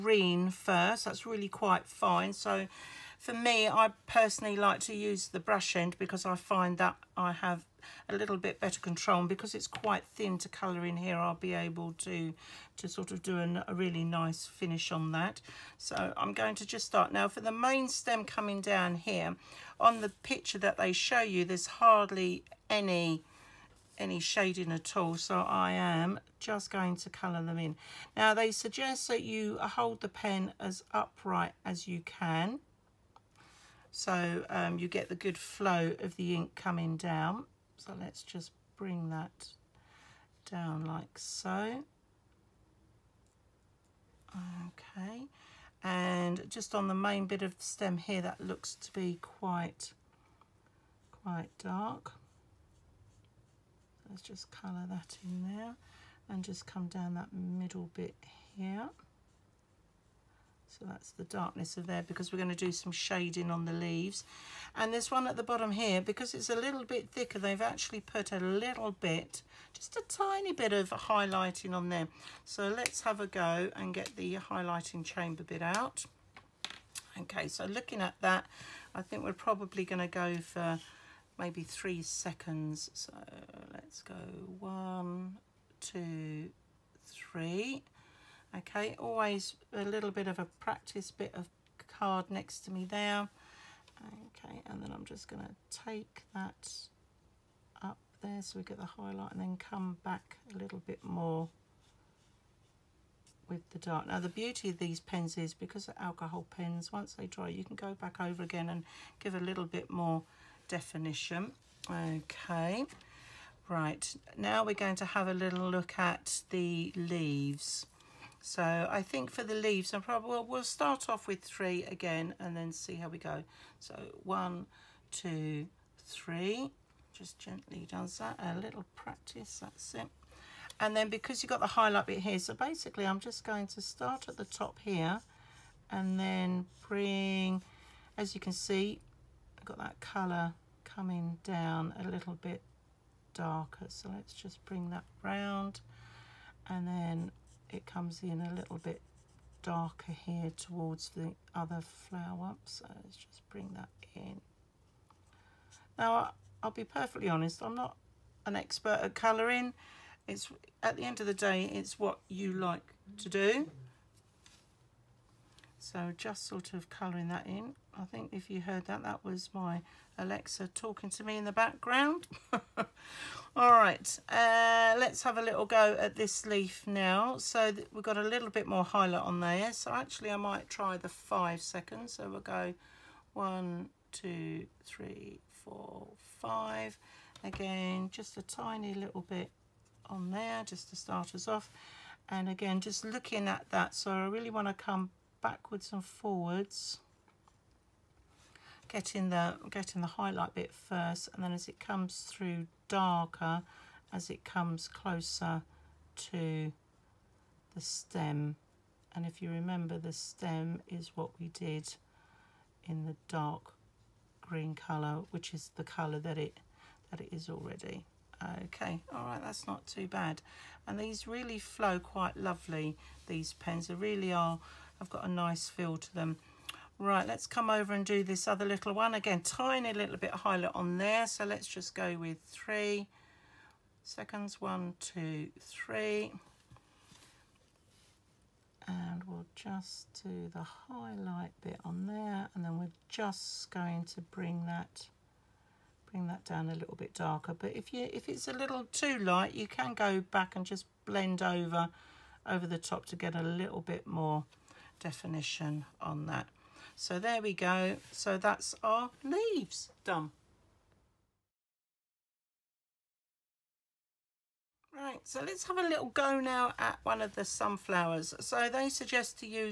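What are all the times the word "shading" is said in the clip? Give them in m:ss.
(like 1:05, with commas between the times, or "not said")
0:24, 1:02.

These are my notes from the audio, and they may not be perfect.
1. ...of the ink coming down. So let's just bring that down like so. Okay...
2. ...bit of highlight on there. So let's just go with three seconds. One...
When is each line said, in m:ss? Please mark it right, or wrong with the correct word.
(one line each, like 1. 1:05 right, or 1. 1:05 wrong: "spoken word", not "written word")
1. 0:36 right
2. 3:50 right.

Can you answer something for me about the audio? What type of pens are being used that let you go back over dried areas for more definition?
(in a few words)
alcohol pens.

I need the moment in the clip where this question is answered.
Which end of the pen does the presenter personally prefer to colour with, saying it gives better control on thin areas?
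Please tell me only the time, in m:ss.
0:05.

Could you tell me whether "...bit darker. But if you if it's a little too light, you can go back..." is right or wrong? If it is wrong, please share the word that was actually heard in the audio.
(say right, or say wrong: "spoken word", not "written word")
right.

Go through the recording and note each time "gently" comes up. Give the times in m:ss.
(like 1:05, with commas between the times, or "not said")
2:07.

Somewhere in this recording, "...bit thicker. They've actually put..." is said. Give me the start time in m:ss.
1:06.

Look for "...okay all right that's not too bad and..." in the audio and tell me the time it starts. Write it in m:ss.
3:38.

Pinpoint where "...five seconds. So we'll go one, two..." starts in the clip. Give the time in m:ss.
3:01.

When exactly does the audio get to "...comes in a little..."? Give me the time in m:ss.
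2:27.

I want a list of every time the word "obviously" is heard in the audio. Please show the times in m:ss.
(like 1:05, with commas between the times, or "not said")
not said.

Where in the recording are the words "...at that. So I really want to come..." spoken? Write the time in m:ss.
3:13.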